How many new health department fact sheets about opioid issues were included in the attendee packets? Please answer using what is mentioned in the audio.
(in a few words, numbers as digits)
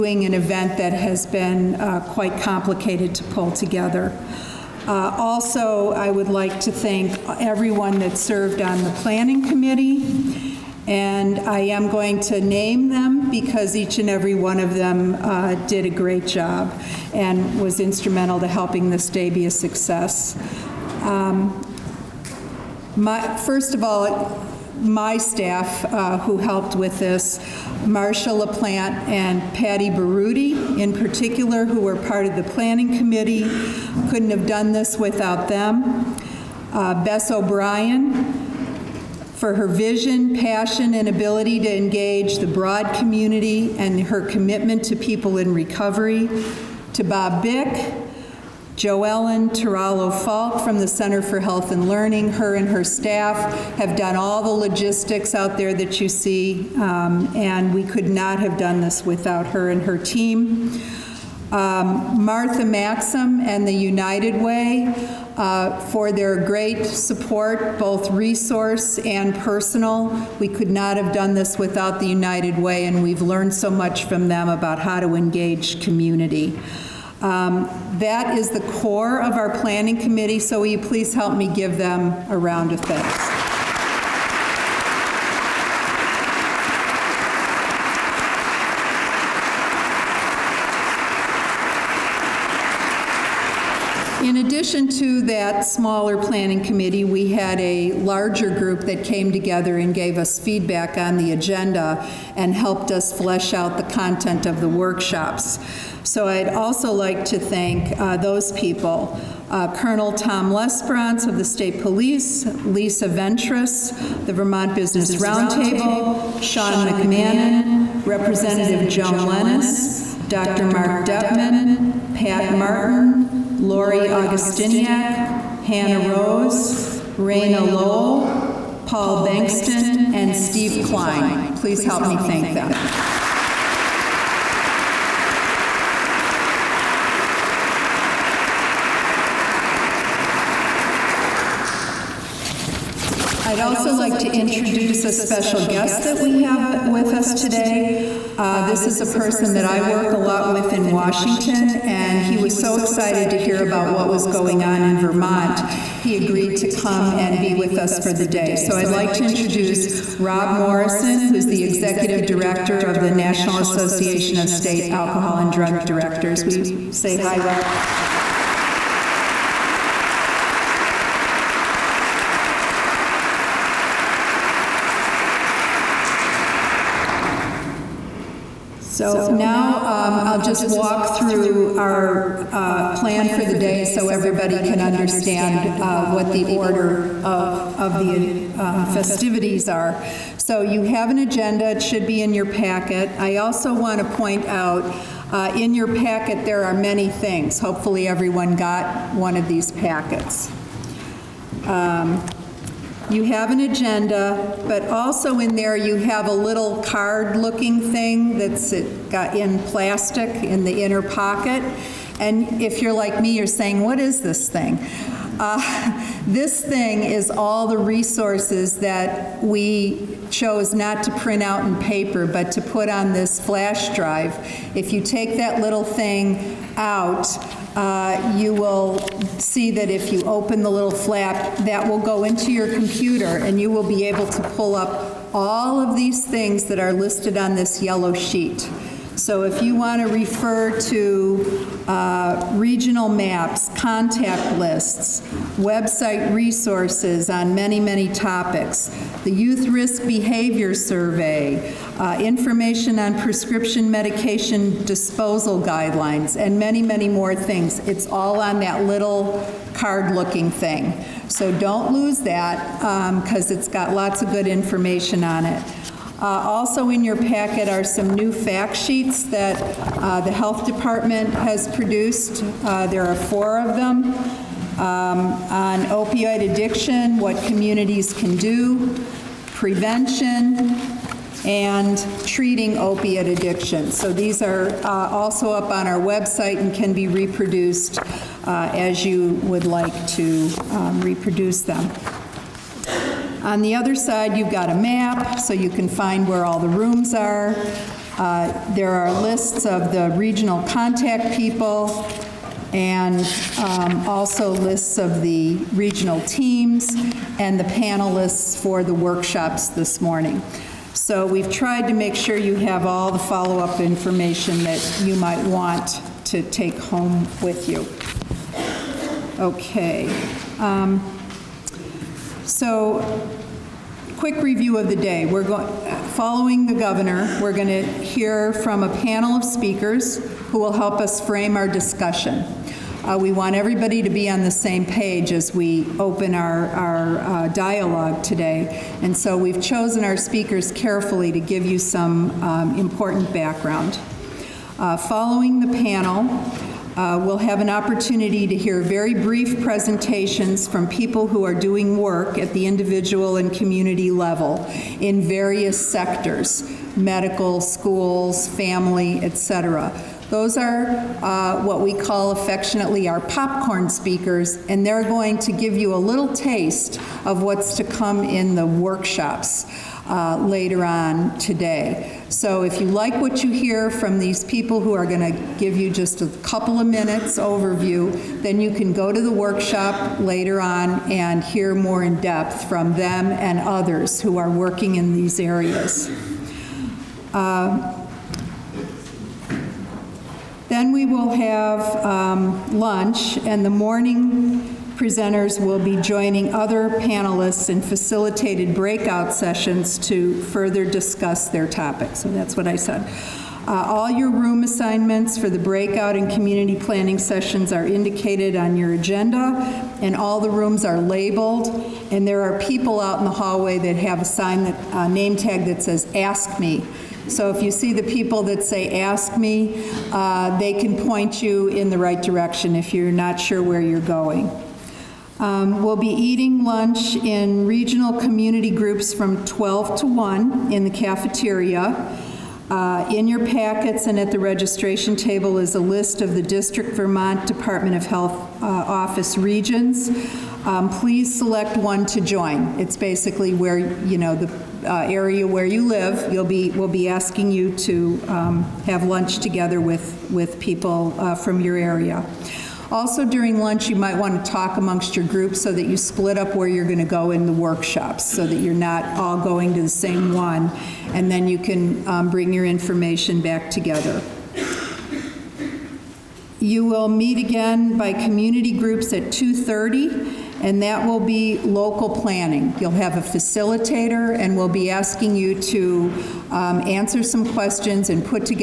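4.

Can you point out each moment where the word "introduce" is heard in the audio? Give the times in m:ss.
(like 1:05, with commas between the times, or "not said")
2:24, 2:39.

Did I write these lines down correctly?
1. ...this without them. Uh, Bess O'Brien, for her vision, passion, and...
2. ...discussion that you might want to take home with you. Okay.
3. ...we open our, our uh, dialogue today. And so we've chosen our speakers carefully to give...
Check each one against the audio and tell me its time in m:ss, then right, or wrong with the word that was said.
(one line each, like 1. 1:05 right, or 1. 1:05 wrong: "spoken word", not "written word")
1. 0:34 right
2. 5:13 wrong: "information", not "discussion"
3. 5:35 right.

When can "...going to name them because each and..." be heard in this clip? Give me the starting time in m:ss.
0:11.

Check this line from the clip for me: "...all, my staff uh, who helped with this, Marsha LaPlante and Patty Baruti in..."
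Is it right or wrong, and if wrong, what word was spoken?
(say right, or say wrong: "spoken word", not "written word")
right.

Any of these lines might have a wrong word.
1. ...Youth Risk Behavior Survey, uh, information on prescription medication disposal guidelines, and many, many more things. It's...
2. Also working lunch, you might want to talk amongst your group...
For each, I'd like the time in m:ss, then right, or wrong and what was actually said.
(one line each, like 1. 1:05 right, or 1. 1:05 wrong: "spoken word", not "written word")
1. 4:09 right
2. 7:32 wrong: "during", not "working".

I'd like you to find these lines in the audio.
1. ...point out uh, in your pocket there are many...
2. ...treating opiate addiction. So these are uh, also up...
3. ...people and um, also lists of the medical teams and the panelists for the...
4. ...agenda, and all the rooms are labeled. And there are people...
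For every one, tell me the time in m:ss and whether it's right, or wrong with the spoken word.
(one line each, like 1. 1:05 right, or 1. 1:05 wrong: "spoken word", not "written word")
1. 3:14 wrong: "packet", not "pocket"
2. 4:42 right
3. 5:01 wrong: "regional", not "medical"
4. 6:48 right.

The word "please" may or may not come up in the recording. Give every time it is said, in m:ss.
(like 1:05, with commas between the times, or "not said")
1:20, 2:11, 7:20.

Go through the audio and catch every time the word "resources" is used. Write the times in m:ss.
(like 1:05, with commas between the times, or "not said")
1:08, 3:37, 4:06.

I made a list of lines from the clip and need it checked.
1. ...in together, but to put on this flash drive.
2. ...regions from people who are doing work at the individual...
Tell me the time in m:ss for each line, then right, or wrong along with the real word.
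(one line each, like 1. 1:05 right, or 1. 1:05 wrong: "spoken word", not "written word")
1. 3:41 wrong: "paper", not "together"
2. 5:49 wrong: "presentations", not "regions".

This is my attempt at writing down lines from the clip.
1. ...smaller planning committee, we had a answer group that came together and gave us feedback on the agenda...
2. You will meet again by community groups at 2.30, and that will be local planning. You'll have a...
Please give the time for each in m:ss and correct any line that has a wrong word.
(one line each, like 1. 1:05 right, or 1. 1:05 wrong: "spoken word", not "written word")
1. 1:35 wrong: "larger", not "answer"
2. 7:46 right.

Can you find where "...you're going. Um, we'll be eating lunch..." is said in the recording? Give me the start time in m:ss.
7:03.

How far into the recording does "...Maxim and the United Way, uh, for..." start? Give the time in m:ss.
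1:02.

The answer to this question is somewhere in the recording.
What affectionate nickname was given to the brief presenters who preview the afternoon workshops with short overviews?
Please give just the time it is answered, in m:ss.
6:03.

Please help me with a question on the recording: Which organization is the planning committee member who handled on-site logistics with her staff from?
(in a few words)
Center for Health and Learning.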